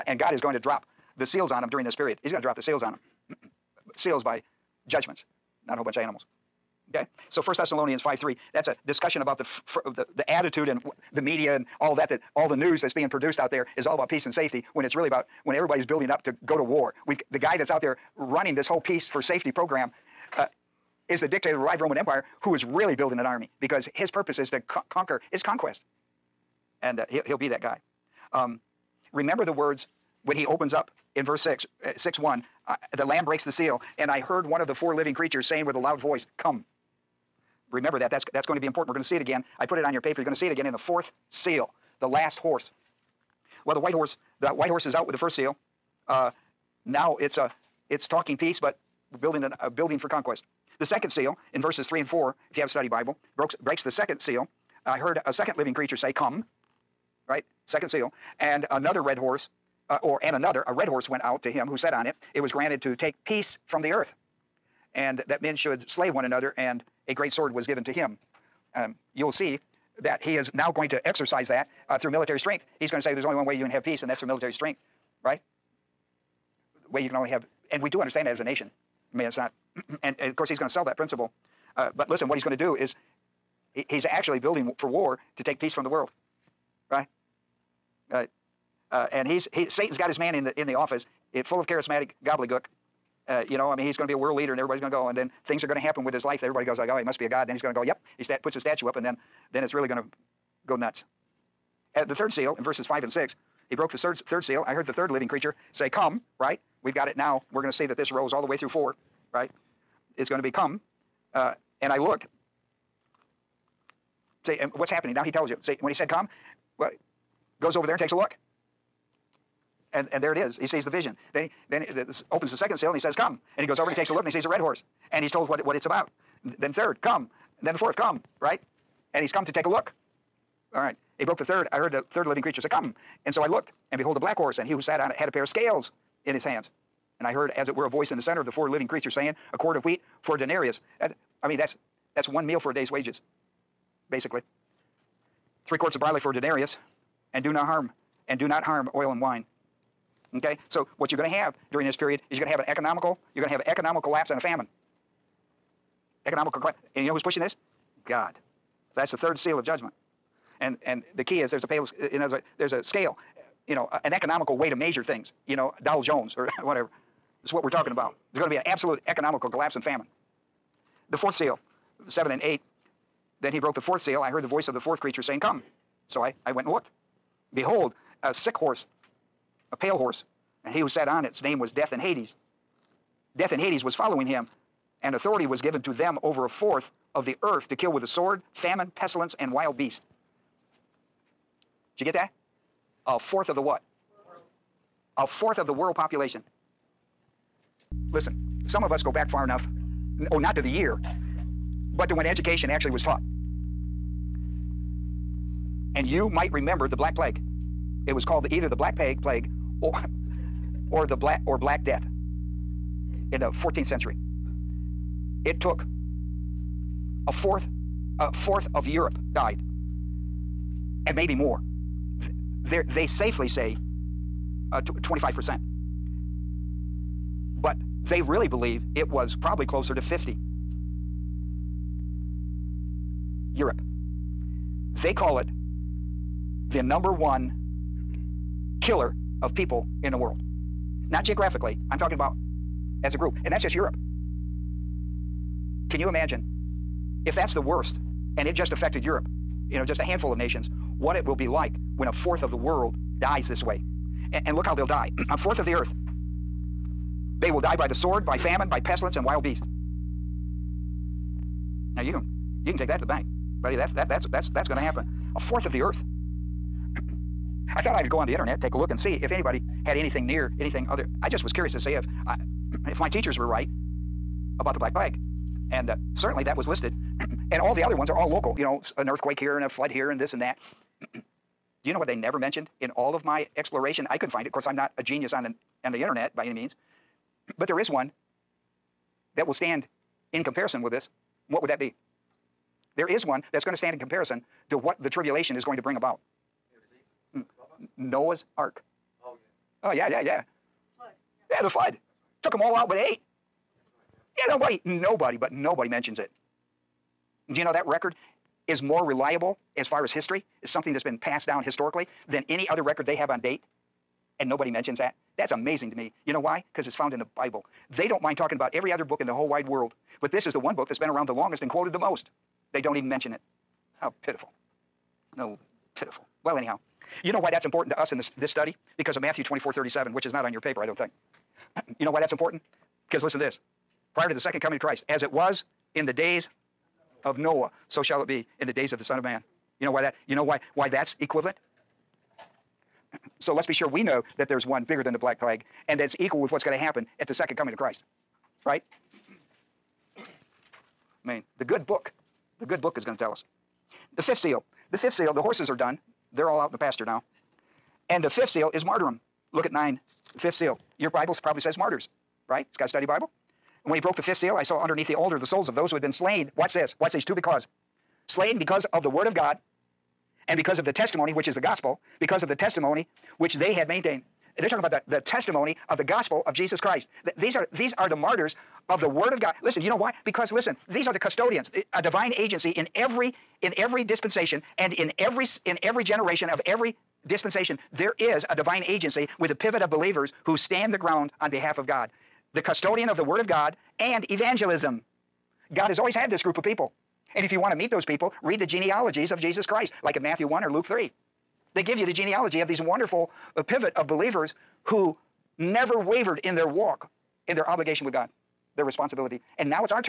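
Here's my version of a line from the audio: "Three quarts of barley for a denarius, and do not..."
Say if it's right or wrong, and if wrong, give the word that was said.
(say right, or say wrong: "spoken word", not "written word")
right.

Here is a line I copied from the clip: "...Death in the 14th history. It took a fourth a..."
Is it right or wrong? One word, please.
wrong.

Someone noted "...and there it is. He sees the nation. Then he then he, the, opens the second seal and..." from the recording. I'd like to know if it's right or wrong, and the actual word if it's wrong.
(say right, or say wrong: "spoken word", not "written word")
wrong: "vision", not "nation".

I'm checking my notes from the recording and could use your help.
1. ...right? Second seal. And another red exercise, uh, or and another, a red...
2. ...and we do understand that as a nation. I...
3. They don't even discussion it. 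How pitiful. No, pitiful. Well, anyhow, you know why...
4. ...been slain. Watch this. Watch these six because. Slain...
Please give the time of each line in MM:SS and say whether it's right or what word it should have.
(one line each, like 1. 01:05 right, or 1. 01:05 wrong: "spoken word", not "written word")
1. 00:57 wrong: "horse", not "exercise"
2. 01:17 right
3. 05:22 wrong: "mention", not "discussion"
4. 06:06 wrong: "two", not "six".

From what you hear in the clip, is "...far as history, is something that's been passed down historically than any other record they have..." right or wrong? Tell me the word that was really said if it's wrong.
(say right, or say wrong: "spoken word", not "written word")
right.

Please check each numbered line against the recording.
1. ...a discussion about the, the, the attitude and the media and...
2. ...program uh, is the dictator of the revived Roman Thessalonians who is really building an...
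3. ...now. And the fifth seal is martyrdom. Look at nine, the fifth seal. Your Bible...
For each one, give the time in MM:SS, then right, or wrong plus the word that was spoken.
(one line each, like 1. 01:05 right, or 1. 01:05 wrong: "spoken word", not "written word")
1. 00:08 right
2. 00:19 wrong: "Empire", not "Thessalonians"
3. 05:57 right.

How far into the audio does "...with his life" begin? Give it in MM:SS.
01:36.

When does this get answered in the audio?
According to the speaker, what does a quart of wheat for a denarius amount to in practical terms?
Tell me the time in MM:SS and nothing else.
02:22.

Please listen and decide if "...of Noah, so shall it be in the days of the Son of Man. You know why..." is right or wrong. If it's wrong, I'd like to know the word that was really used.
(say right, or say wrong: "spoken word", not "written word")
right.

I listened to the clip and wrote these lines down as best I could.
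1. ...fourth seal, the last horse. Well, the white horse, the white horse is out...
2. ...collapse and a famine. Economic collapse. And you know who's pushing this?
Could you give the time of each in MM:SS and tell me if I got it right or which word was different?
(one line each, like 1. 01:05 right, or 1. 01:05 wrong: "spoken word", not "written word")
1. 00:40 right
2. 02:34 right.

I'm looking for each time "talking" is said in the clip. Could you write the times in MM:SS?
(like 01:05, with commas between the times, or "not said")
00:48, 02:47, 04:01, 05:18, 06:14.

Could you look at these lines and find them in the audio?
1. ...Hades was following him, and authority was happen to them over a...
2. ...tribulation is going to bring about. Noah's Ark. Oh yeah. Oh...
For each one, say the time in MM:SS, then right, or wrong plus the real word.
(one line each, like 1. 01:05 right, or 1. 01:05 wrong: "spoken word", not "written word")
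1. 03:03 wrong: "given", not "happen"
2. 04:55 right.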